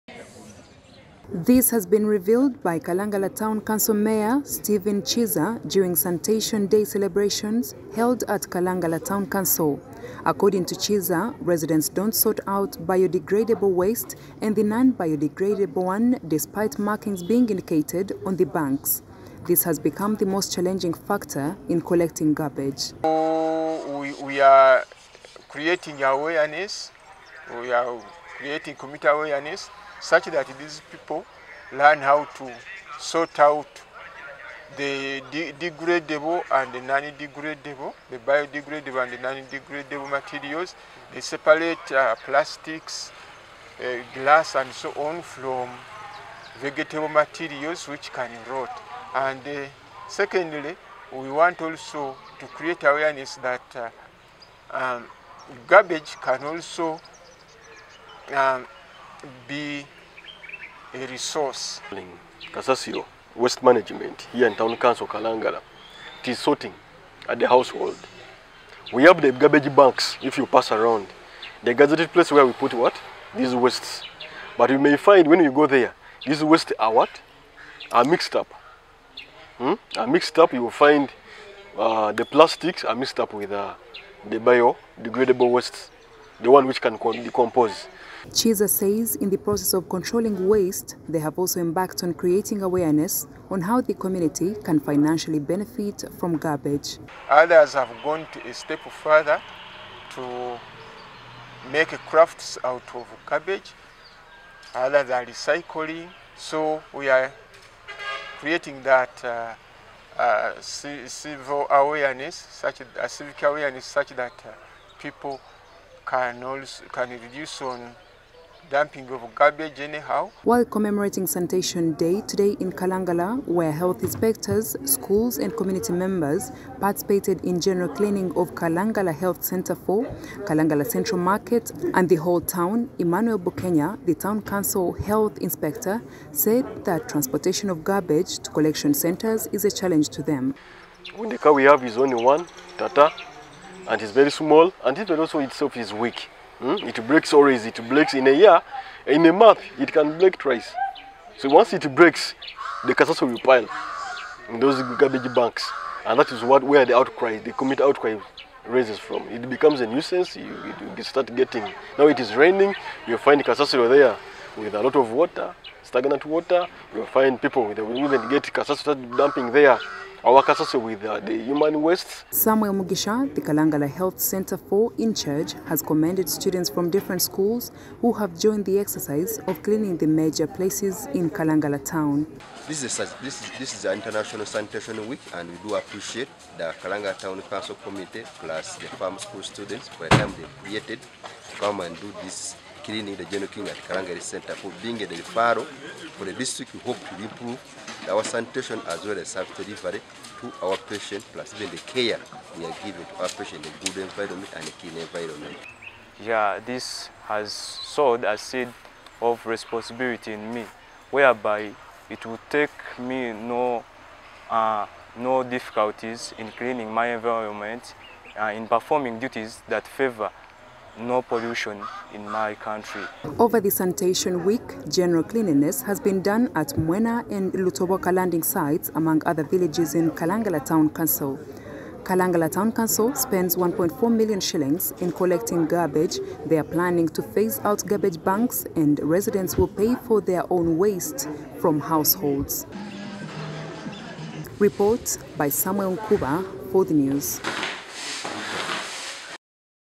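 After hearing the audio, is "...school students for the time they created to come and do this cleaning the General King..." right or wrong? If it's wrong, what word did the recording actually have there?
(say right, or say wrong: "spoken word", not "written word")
right.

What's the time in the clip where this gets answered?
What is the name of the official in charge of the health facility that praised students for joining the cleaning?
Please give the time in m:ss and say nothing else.
2:52.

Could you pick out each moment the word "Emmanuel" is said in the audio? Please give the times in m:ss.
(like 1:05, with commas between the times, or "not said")
2:12.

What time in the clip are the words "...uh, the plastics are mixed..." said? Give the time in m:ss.
1:21.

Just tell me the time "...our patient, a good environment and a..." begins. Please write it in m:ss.
3:23.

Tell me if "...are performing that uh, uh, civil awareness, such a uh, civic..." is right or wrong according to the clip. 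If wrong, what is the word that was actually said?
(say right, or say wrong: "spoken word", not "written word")
wrong: "creating", not "performing".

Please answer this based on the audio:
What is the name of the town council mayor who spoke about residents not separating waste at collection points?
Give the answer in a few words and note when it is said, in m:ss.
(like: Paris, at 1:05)
Stephen Chiza, at 0:04.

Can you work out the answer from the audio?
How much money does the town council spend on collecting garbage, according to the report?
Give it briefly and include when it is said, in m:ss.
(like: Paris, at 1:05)
1.4 million shillings, at 3:53.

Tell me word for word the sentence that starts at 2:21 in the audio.
When the car we have is only one, Tata, and it's very small, and it also itself is weak.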